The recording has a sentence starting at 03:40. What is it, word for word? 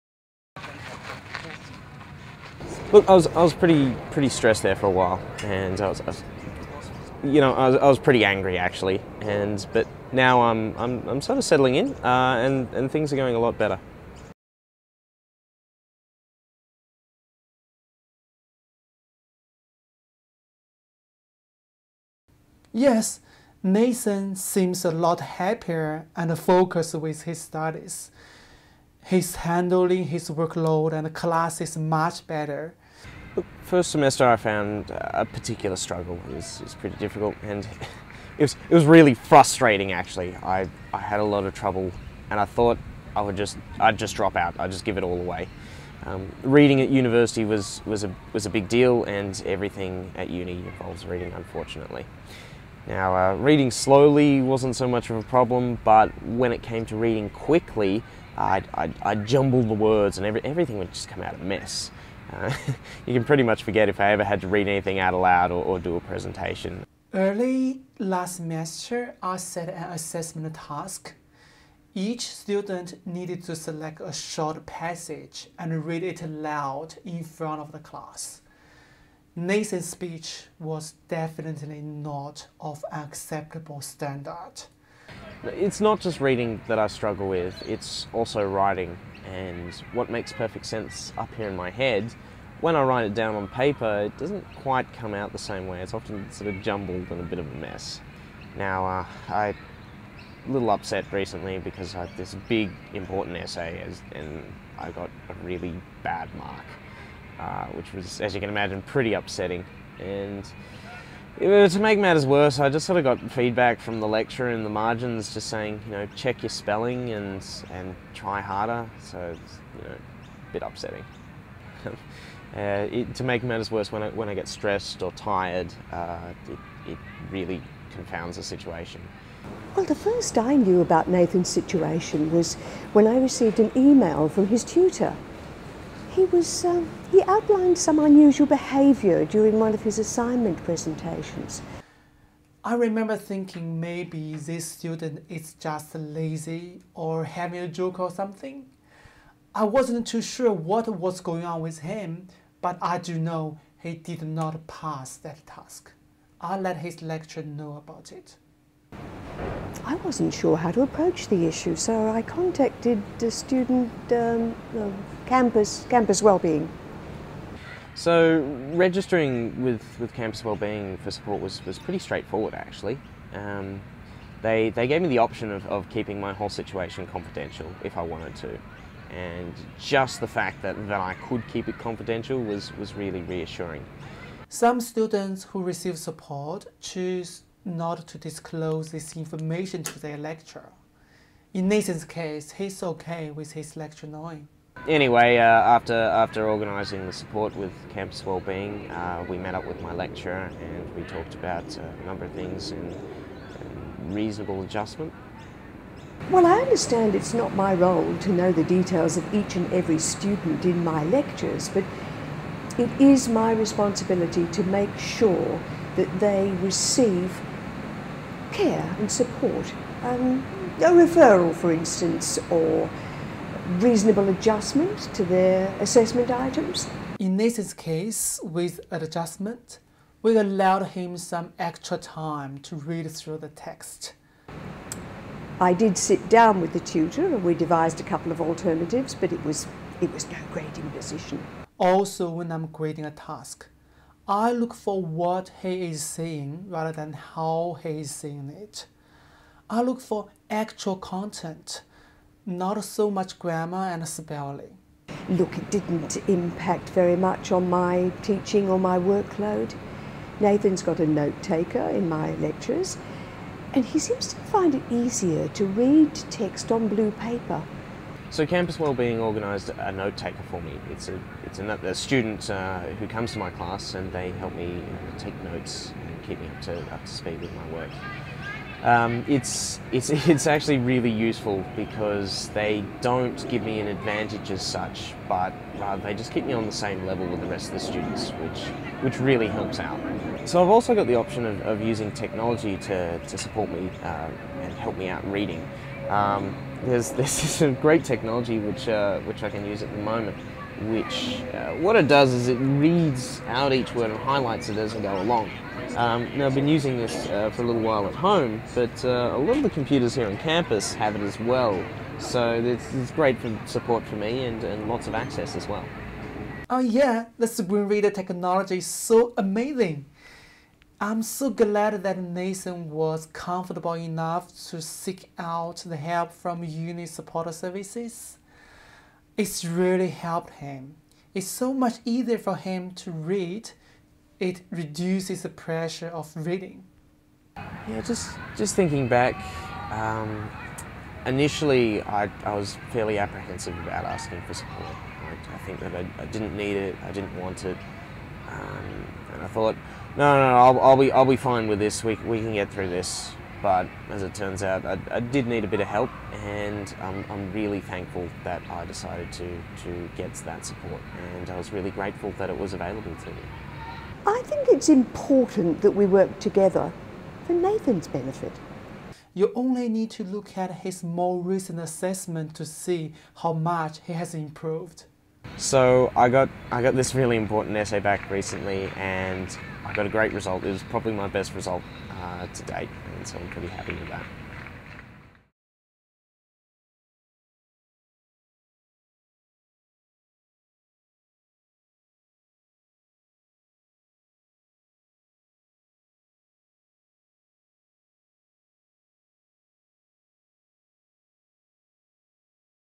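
Um, a referral, for instance, or reasonable adjustment to their assessment items.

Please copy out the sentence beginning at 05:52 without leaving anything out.
We, we can get through this.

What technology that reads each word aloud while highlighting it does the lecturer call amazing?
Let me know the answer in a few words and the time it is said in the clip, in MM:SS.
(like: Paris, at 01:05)
Screen reader, at 05:17.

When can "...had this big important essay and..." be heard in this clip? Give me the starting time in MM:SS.
01:42.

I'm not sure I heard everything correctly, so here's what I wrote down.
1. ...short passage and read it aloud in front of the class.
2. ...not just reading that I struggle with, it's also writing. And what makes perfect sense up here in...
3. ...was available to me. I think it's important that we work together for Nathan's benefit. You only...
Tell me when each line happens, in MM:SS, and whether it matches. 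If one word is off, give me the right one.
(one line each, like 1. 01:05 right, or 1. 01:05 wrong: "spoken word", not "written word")
1. 01:14 right
2. 01:25 right
3. 06:02 right.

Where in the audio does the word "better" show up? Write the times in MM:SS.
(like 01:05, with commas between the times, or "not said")
00:13, 00:32.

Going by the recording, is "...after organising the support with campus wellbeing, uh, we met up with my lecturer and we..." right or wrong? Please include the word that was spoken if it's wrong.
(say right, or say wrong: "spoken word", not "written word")
right.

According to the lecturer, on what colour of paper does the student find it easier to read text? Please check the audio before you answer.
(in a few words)
Blue.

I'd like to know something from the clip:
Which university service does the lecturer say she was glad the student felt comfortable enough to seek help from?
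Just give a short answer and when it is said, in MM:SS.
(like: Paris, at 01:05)
Uni Support Services, at 05:26.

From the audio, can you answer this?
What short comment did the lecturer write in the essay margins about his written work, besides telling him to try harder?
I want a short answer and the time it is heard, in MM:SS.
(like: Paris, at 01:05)
Check your spelling, at 01:56.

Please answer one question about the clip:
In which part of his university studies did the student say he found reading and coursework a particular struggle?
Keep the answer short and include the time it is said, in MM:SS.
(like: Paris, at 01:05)
First semester, at 00:33.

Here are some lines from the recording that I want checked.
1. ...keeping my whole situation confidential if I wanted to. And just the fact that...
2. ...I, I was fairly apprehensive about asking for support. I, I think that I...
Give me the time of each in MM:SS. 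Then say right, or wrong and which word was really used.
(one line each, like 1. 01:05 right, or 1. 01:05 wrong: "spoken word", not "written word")
1. 02:55 right
2. 05:42 right.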